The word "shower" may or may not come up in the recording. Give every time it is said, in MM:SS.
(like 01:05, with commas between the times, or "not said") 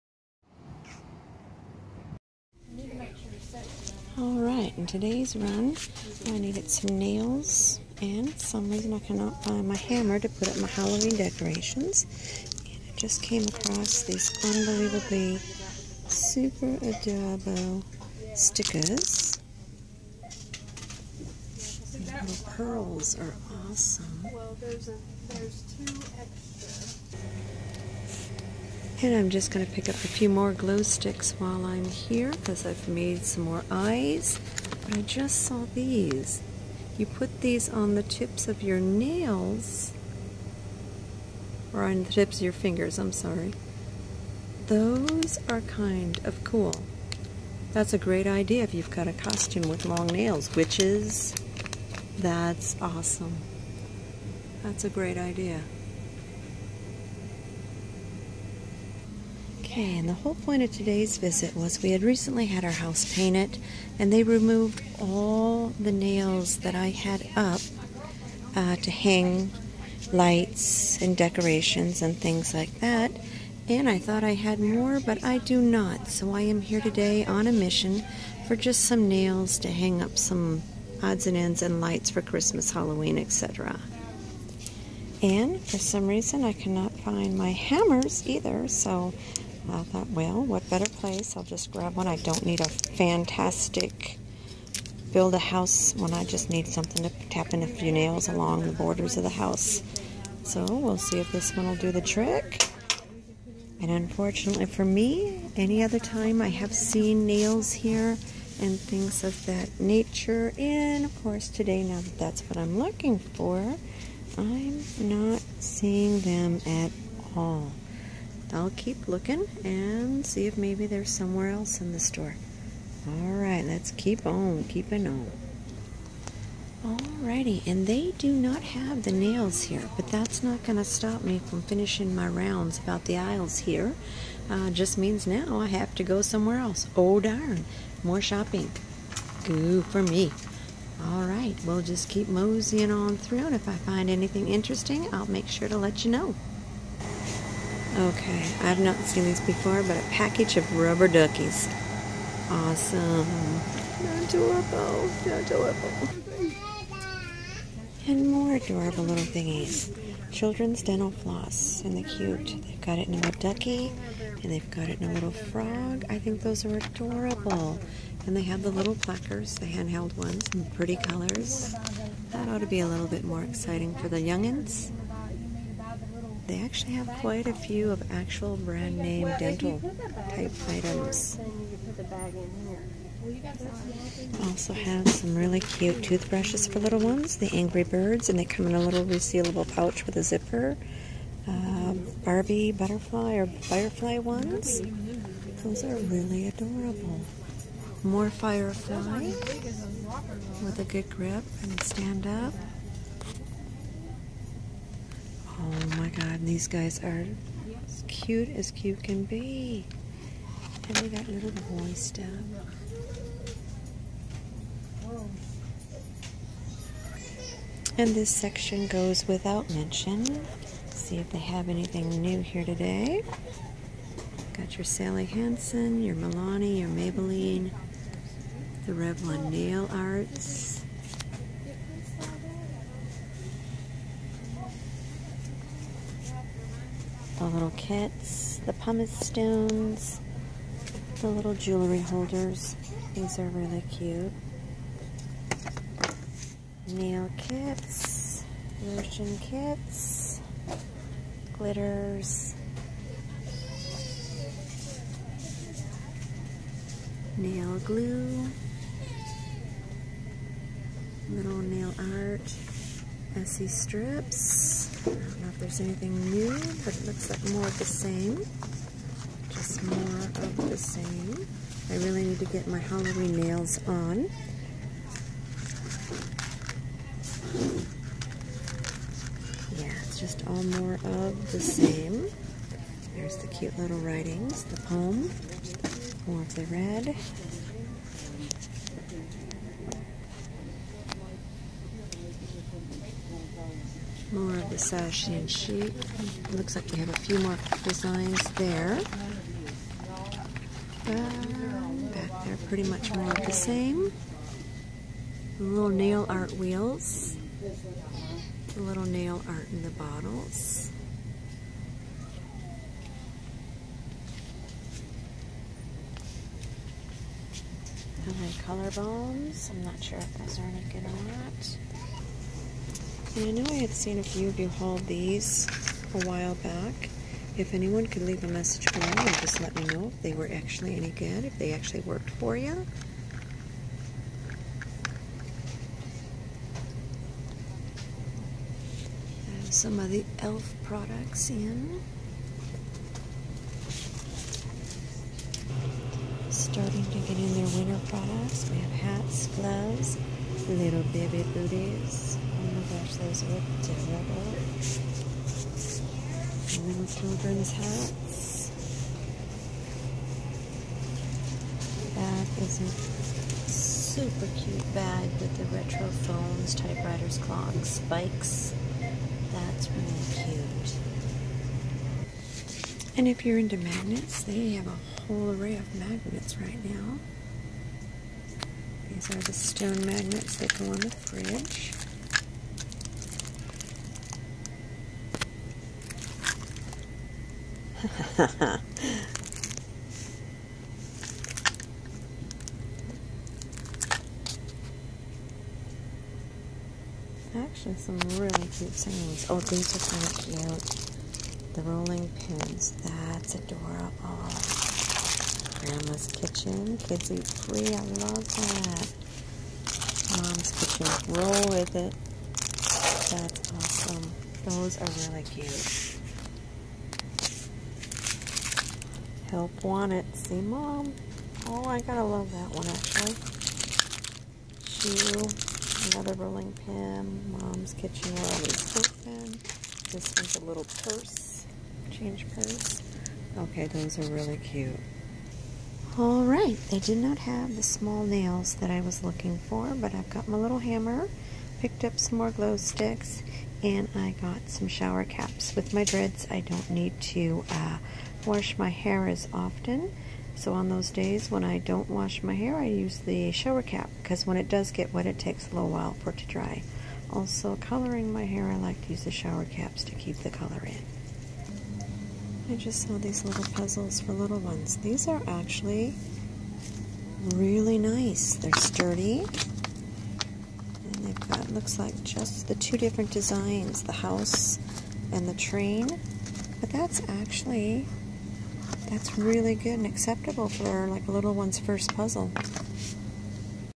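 07:24, 07:33, 07:39.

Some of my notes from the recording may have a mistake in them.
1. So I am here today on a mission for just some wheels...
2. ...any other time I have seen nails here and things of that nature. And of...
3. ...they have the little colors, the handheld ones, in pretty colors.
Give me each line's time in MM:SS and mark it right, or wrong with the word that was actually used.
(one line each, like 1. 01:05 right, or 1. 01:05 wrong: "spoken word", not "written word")
1. 01:16 wrong: "nails", not "wheels"
2. 01:45 right
3. 02:48 wrong: "plackers", not "colors".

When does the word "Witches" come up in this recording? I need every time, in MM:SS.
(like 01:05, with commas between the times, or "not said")
00:50.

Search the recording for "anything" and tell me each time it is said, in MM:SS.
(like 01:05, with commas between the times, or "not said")
02:24, 03:41, 04:25.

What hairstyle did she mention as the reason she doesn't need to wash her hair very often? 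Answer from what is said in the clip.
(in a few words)
Dreads.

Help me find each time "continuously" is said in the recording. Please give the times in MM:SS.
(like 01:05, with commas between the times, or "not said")
not said.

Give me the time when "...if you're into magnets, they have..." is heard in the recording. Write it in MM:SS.
06:13.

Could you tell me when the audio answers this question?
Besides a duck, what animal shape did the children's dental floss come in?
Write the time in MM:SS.
02:45.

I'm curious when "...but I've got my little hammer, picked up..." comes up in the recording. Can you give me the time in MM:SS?
07:19.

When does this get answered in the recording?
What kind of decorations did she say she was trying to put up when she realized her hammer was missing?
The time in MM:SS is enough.
00:10.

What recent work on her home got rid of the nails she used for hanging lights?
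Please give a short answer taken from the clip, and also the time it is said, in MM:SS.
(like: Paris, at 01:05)
House painted, at 01:02.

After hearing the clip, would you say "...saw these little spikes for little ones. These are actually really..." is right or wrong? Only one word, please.
wrong.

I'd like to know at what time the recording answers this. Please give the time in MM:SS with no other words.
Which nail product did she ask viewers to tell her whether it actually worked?
05:18.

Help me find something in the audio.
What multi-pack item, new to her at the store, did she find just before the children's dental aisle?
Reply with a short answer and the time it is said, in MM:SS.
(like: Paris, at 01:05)
Rubber duckies, at 02:30.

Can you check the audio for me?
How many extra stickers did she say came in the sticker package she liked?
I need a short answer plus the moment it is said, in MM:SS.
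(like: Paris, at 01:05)
2, at 00:25.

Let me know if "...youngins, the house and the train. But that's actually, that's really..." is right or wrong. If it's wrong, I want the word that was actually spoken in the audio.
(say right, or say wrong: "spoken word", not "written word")
wrong: "designs", not "youngins".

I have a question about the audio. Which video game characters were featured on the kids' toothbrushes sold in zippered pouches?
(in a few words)
Angry Birds.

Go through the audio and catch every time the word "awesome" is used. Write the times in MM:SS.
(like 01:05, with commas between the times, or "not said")
00:23, 00:52, 02:32, 06:53.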